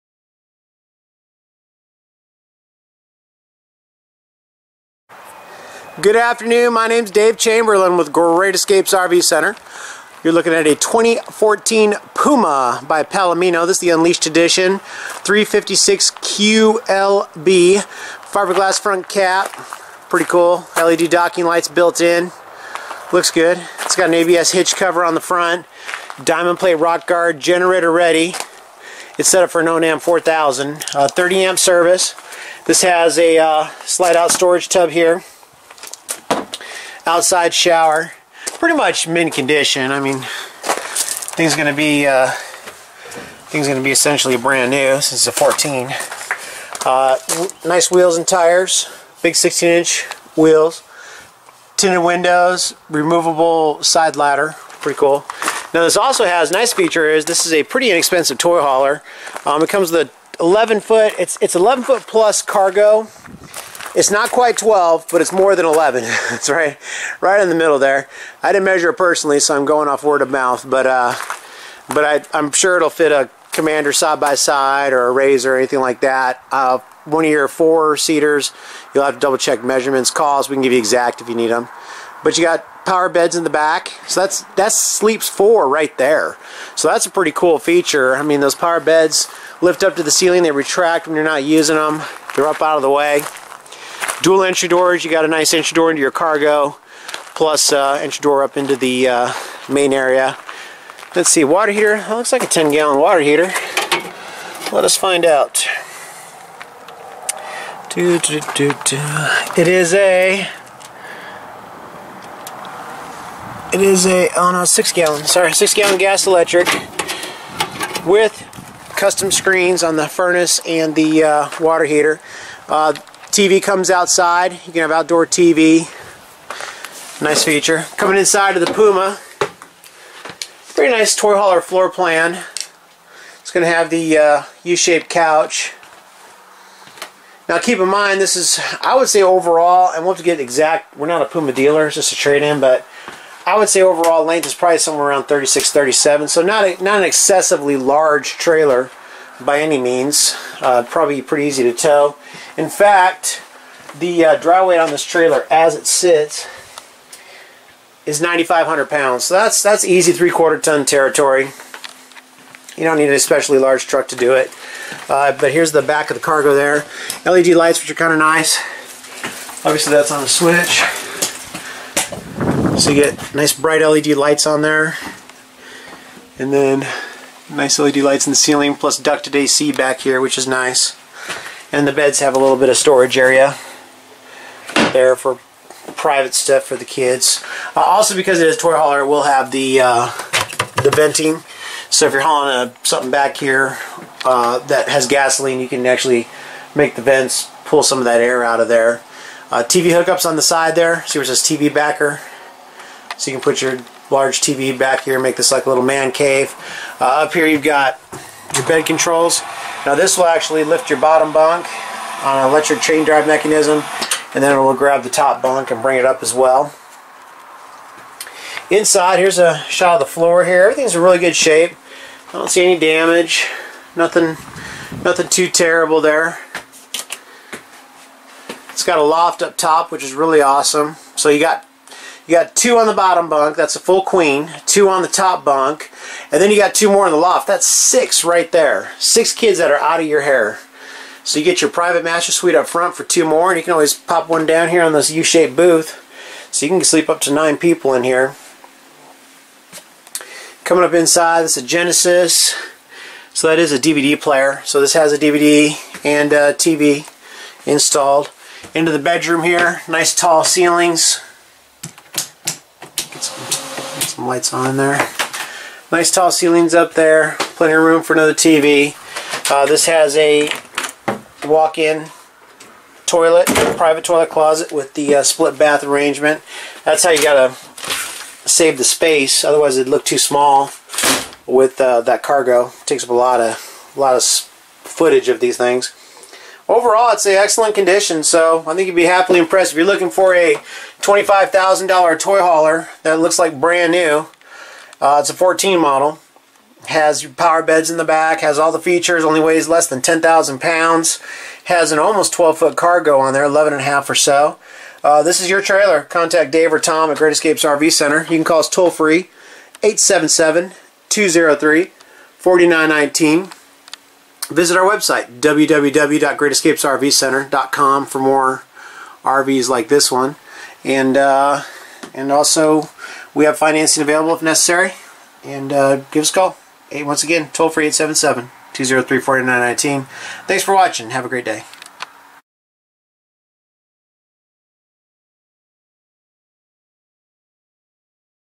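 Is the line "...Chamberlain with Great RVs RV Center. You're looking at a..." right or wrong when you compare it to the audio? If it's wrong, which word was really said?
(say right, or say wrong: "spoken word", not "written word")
wrong: "Escapes", not "RVs".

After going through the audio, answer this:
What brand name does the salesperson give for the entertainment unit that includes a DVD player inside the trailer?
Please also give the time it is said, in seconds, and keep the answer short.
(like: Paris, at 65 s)
Genesis, at 251 s.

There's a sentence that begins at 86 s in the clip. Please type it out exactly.
So that's a pretty cool feature.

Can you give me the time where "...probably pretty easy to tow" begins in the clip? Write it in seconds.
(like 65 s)
150 s.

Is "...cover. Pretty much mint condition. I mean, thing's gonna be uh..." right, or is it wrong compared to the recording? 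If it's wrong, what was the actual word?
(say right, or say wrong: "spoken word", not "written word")
wrong: "shower", not "cover".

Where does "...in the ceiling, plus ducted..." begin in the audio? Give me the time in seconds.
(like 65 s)
178 s.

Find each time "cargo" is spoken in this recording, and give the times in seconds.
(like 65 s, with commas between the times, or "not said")
62 s, 96 s, 166 s, 282 s, 302 s.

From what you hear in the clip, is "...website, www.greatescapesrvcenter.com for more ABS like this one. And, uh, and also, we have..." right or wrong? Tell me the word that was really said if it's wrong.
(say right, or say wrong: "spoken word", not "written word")
wrong: "RVs", not "ABS".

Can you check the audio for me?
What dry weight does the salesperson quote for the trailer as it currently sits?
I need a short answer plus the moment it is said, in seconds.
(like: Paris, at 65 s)
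9,500 pounds, at 158 s.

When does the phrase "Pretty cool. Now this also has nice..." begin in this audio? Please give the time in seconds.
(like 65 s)
54 s.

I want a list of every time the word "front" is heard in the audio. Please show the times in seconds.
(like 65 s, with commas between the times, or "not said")
18 s, 25 s, 242 s.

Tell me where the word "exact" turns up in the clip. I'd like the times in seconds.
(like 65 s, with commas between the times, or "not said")
80 s, 140 s.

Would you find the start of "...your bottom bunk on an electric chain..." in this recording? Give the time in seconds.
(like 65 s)
210 s.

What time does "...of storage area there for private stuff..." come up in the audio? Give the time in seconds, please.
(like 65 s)
182 s.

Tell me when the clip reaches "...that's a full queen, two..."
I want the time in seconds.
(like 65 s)
233 s.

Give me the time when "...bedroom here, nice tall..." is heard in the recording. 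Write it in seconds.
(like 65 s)
258 s.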